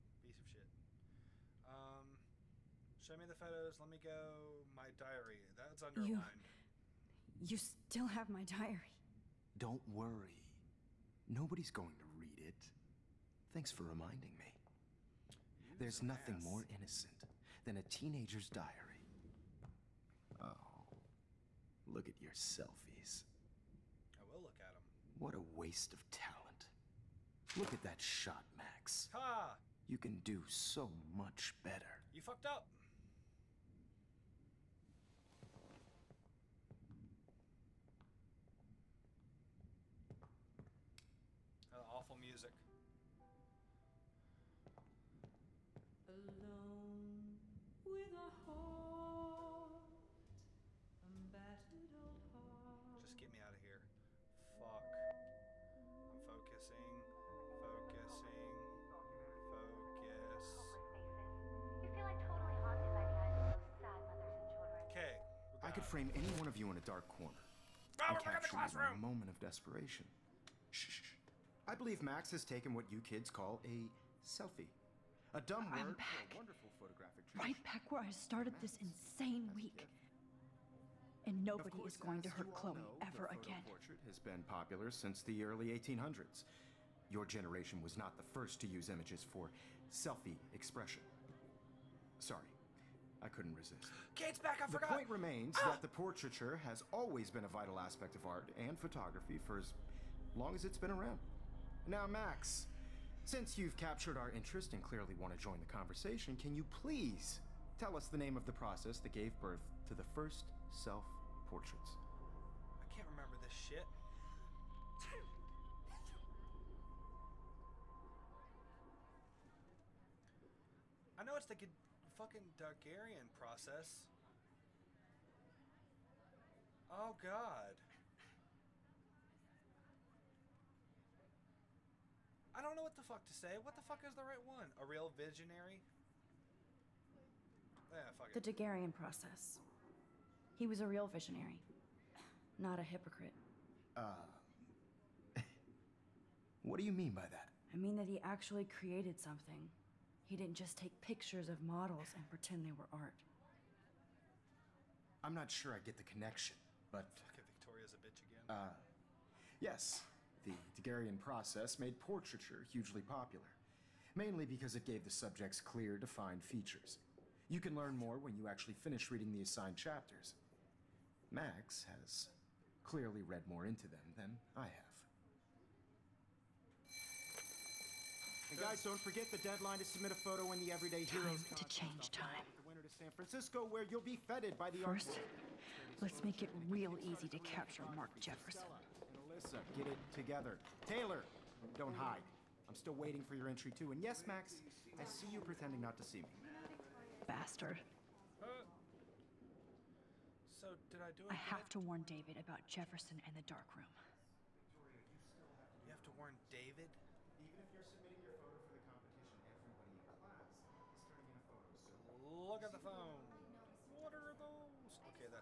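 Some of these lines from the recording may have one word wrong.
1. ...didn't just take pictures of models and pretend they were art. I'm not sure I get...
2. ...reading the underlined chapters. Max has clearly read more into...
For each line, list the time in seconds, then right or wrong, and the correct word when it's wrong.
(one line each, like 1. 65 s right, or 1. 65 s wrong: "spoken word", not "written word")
1. 150 s right
2. 169 s wrong: "assigned", not "underlined".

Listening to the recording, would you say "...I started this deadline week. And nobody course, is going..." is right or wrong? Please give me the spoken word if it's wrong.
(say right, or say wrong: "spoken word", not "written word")
wrong: "insane", not "deadline".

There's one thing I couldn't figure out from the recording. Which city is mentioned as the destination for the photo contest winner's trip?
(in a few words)
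San Francisco.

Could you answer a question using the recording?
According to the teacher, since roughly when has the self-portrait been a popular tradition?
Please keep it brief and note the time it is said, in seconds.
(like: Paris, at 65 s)
early 1800s, at 85 s.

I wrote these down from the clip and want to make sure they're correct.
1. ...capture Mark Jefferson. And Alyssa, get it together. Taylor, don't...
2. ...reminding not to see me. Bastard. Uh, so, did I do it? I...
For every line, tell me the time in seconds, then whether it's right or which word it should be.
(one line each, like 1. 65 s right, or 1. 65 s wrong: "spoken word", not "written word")
1. 187 s right
2. 195 s wrong: "pretending", not "reminding".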